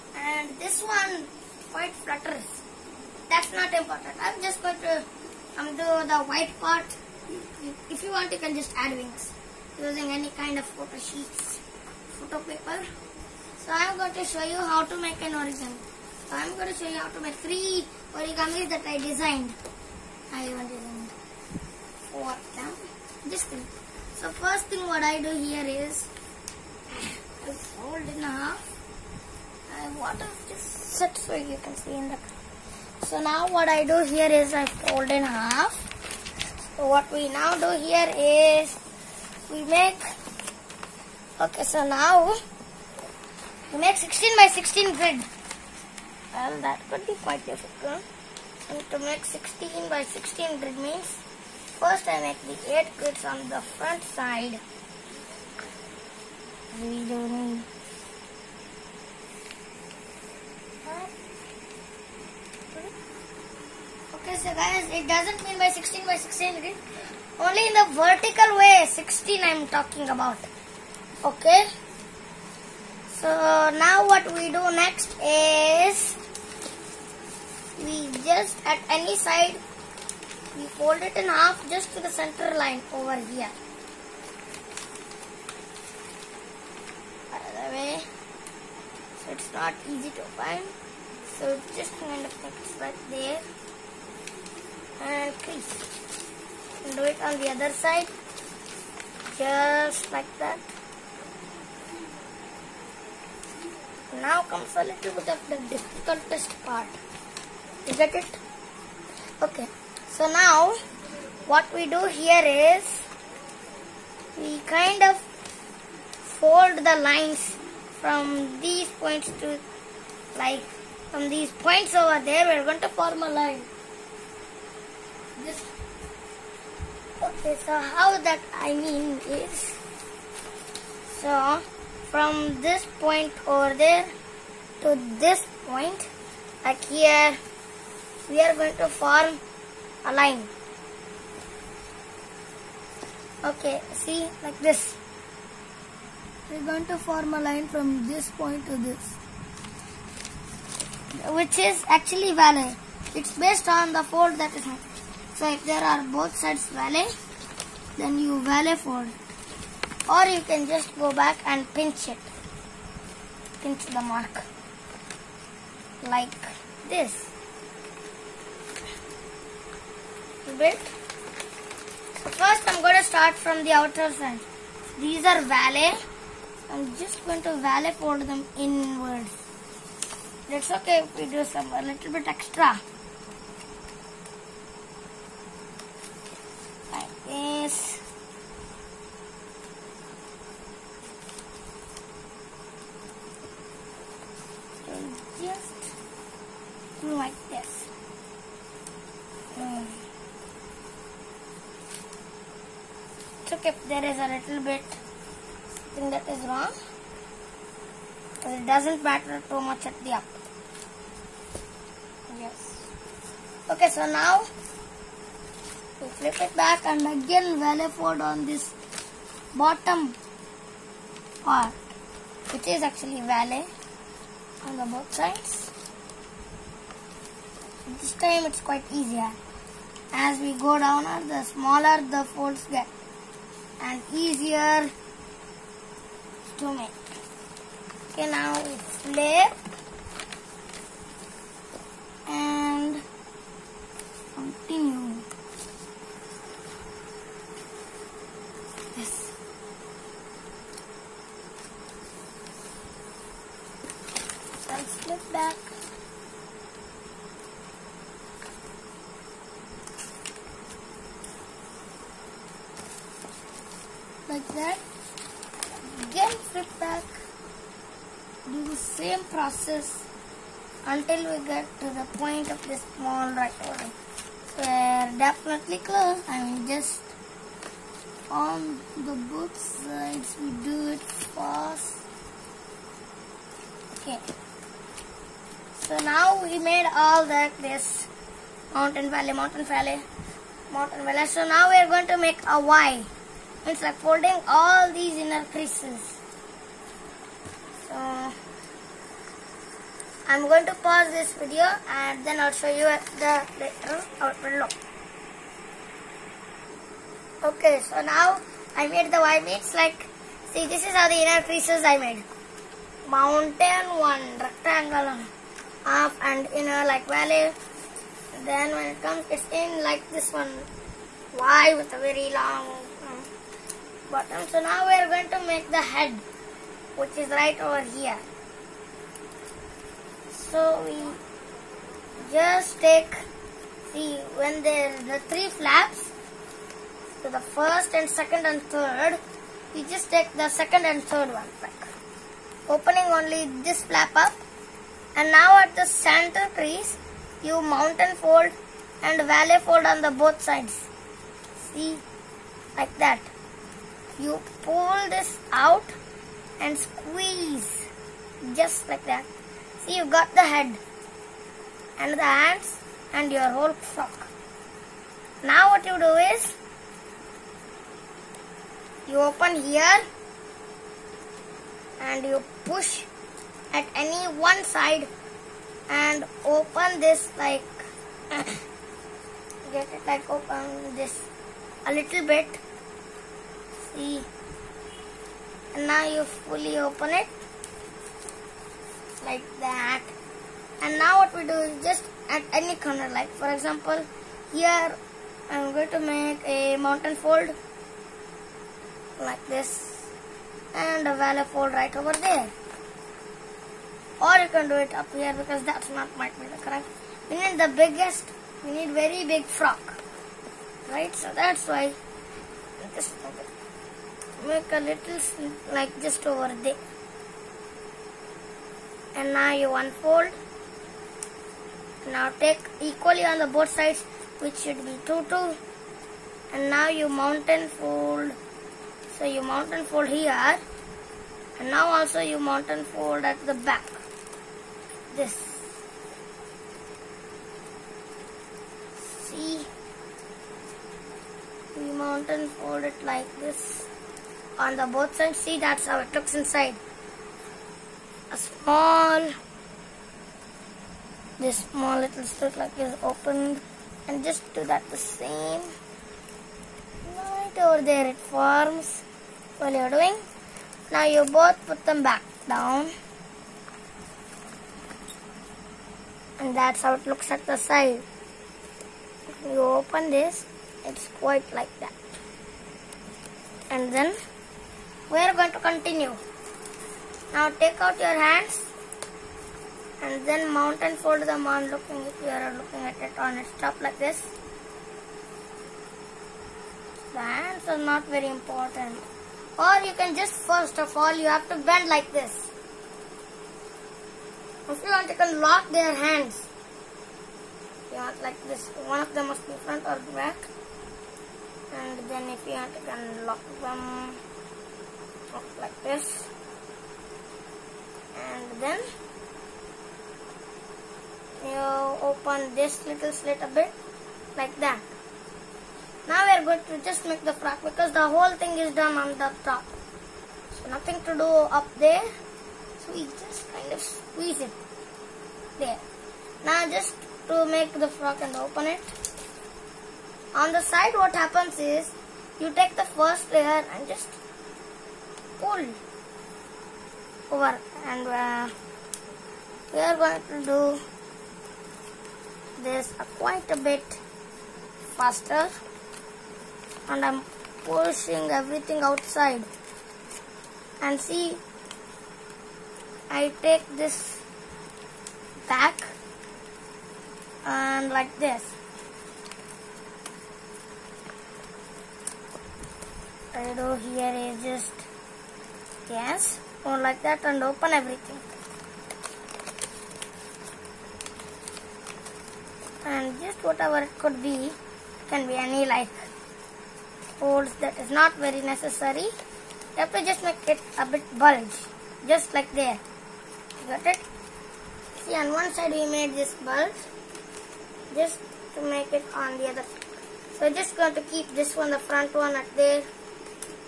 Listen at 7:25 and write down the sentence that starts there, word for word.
See, that's how it looks inside.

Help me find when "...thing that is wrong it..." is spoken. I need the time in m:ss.
3:24.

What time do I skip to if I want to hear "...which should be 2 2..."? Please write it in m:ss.
7:04.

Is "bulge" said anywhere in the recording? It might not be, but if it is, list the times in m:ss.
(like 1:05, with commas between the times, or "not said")
9:41, 9:46.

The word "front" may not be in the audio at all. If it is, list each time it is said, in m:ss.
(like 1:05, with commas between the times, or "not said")
0:53, 8:19, 9:51.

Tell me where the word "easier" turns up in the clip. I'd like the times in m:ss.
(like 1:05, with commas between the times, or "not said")
3:49, 3:54.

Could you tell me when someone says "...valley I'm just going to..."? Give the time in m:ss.
2:55.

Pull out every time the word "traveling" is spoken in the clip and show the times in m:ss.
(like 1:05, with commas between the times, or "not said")
not said.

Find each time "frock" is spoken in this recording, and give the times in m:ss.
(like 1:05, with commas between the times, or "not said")
6:03, 6:49, 8:37, 8:47.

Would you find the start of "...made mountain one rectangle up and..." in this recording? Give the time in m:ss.
5:11.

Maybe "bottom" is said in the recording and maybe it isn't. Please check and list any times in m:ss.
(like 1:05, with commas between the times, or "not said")
3:39, 5:24.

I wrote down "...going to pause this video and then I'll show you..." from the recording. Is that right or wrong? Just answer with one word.
right.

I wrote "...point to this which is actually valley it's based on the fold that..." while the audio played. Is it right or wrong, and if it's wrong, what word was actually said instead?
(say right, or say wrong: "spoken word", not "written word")
right.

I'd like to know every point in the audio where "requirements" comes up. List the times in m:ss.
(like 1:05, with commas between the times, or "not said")
not said.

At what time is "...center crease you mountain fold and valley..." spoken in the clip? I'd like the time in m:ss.
5:45.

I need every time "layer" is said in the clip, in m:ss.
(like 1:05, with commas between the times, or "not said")
8:53.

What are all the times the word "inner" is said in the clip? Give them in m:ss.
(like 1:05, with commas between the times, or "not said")
4:55, 5:11, 5:16.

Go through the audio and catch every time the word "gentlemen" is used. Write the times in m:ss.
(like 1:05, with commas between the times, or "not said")
not said.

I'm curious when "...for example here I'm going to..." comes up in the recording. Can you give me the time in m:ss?
6:33.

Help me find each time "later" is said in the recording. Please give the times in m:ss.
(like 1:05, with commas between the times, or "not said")
5:03.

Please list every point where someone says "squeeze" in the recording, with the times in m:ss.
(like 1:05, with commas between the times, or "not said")
5:56, 8:43.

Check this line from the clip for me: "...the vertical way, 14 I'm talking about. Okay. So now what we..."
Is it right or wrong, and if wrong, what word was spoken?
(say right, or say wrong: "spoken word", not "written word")
wrong: "16", not "14".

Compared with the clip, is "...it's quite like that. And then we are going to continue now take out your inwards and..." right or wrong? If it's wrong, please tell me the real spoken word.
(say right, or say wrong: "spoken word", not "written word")
wrong: "hands", not "inwards".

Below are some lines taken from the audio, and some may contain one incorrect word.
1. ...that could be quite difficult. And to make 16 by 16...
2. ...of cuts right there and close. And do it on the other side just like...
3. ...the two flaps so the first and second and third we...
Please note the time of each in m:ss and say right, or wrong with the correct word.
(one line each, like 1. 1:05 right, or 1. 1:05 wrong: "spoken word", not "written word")
1. 0:46 right
2. 1:32 wrong: "crease", not "close"
3. 5:35 wrong: "three", not "two".